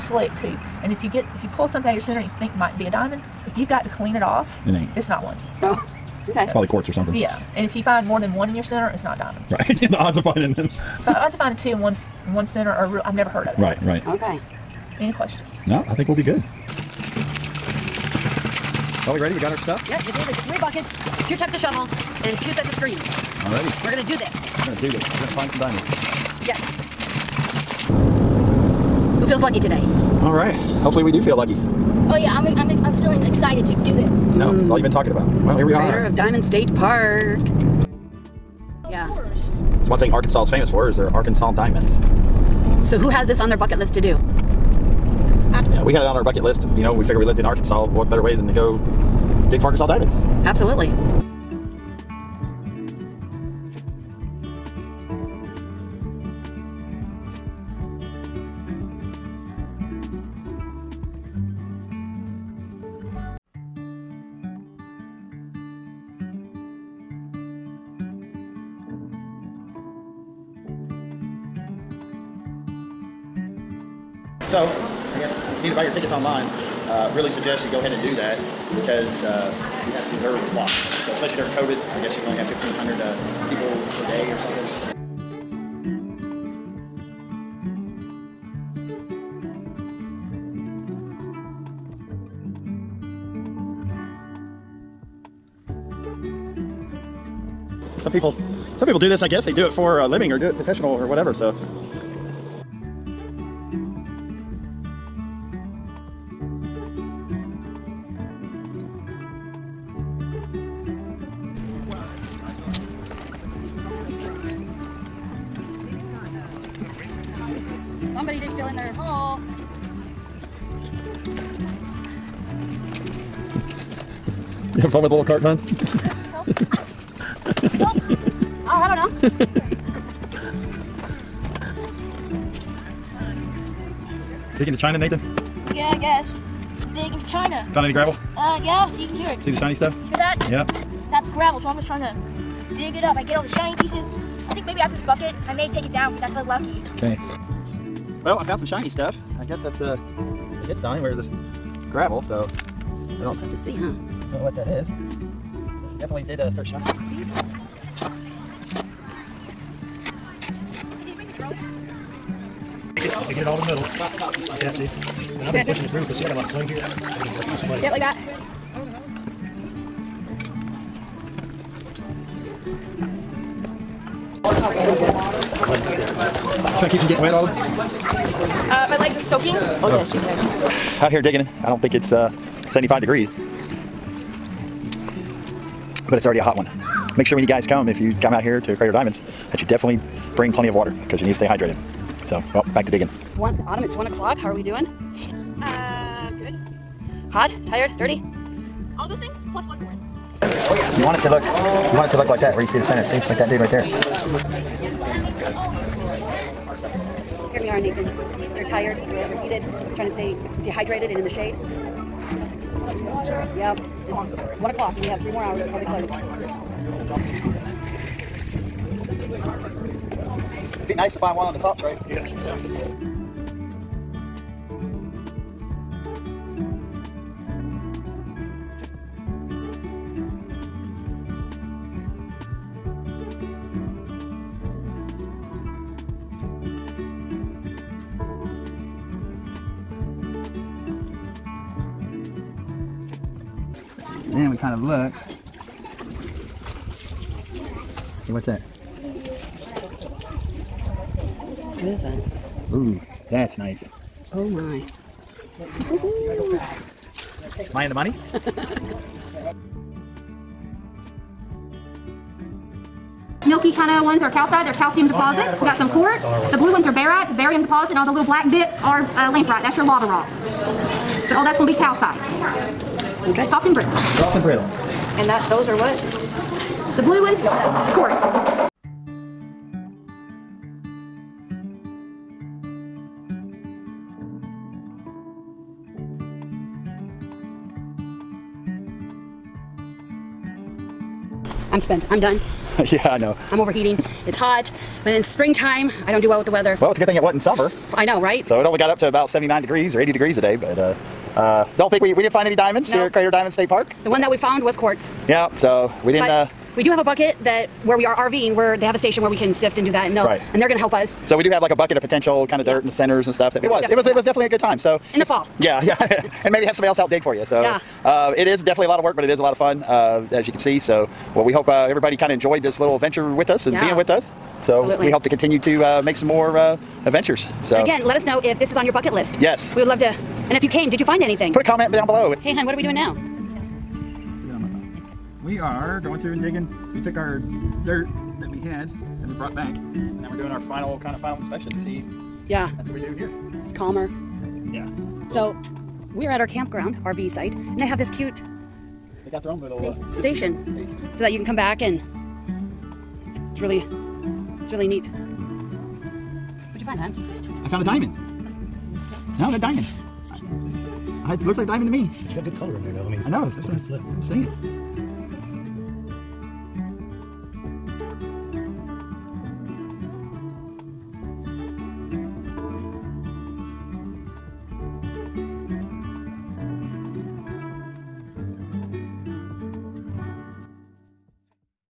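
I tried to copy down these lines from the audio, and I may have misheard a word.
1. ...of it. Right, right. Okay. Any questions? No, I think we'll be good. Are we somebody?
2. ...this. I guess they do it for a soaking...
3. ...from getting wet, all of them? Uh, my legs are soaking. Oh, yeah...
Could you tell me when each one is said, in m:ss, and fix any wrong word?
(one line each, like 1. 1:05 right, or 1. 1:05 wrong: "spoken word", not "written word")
1. 0:13 wrong: "ready", not "somebody"
2. 1:39 wrong: "living", not "soaking"
3. 2:56 right.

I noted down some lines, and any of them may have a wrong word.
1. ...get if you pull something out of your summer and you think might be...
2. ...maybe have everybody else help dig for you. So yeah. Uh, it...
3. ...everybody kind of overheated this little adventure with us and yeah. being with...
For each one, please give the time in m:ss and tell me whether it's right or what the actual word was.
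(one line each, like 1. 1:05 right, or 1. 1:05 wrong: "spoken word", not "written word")
1. 0:01 wrong: "center", not "summer"
2. 5:16 wrong: "somebody", not "everybody"
3. 5:21 wrong: "enjoyed", not "overheated".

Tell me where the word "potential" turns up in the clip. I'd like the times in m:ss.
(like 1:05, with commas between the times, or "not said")
5:12.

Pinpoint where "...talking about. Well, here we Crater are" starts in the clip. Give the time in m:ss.
0:34.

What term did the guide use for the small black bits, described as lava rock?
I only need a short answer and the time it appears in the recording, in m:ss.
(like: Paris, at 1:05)
lamproite, at 4:29.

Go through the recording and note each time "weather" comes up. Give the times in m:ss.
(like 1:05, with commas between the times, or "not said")
4:56.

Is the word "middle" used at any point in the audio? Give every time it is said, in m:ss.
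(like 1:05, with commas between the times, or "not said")
2:43.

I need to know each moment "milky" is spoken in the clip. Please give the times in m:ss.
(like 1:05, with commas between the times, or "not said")
4:23.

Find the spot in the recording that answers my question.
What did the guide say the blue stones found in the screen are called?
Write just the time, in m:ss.
4:26.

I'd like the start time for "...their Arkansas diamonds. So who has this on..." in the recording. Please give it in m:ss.
0:40.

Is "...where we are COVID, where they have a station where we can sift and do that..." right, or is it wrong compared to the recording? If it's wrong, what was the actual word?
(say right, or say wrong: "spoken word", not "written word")
wrong: "RVing", not "COVID".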